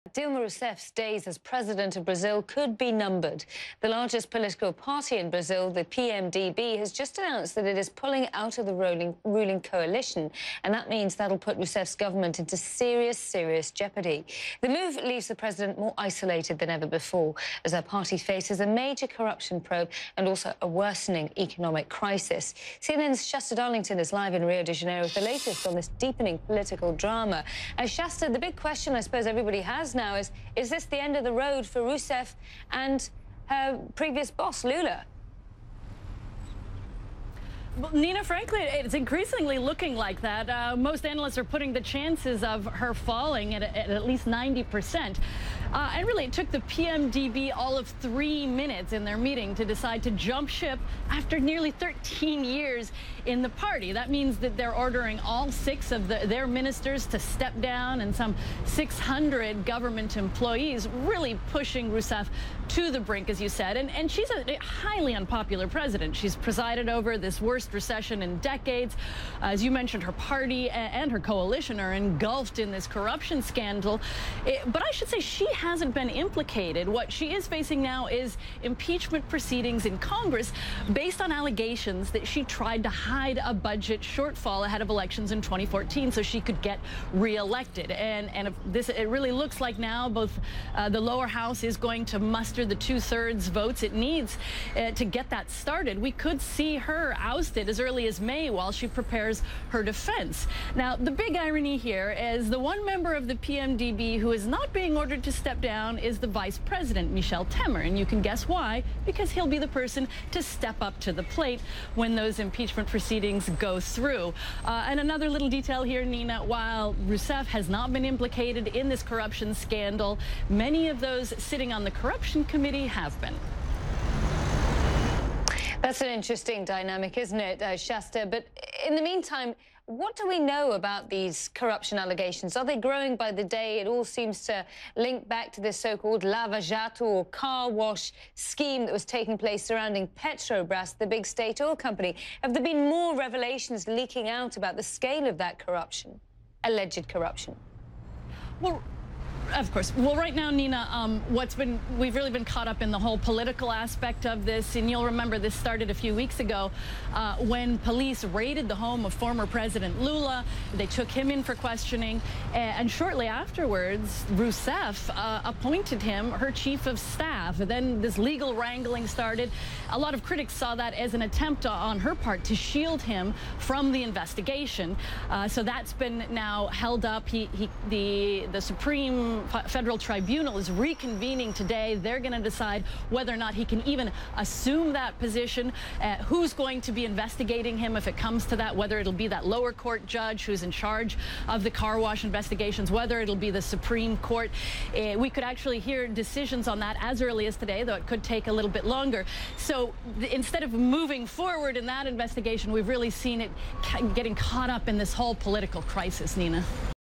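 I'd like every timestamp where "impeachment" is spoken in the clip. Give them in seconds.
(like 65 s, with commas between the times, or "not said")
78 s, 112 s.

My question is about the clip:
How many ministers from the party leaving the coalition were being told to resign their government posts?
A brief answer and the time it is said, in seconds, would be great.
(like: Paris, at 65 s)
6, at 55 s.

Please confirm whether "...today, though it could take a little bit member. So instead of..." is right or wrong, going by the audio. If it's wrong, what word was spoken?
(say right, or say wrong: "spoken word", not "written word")
wrong: "longer", not "member".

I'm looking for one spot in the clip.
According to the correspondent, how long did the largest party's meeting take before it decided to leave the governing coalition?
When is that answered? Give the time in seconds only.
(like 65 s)
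48 s.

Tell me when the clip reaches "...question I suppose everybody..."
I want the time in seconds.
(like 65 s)
28 s.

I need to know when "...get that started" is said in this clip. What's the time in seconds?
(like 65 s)
95 s.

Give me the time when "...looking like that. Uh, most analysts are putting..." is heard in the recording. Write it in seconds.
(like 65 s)
39 s.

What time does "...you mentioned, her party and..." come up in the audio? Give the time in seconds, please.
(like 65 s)
69 s.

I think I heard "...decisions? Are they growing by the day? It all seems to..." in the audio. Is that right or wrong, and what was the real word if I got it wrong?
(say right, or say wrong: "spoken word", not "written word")
wrong: "allegations", not "decisions".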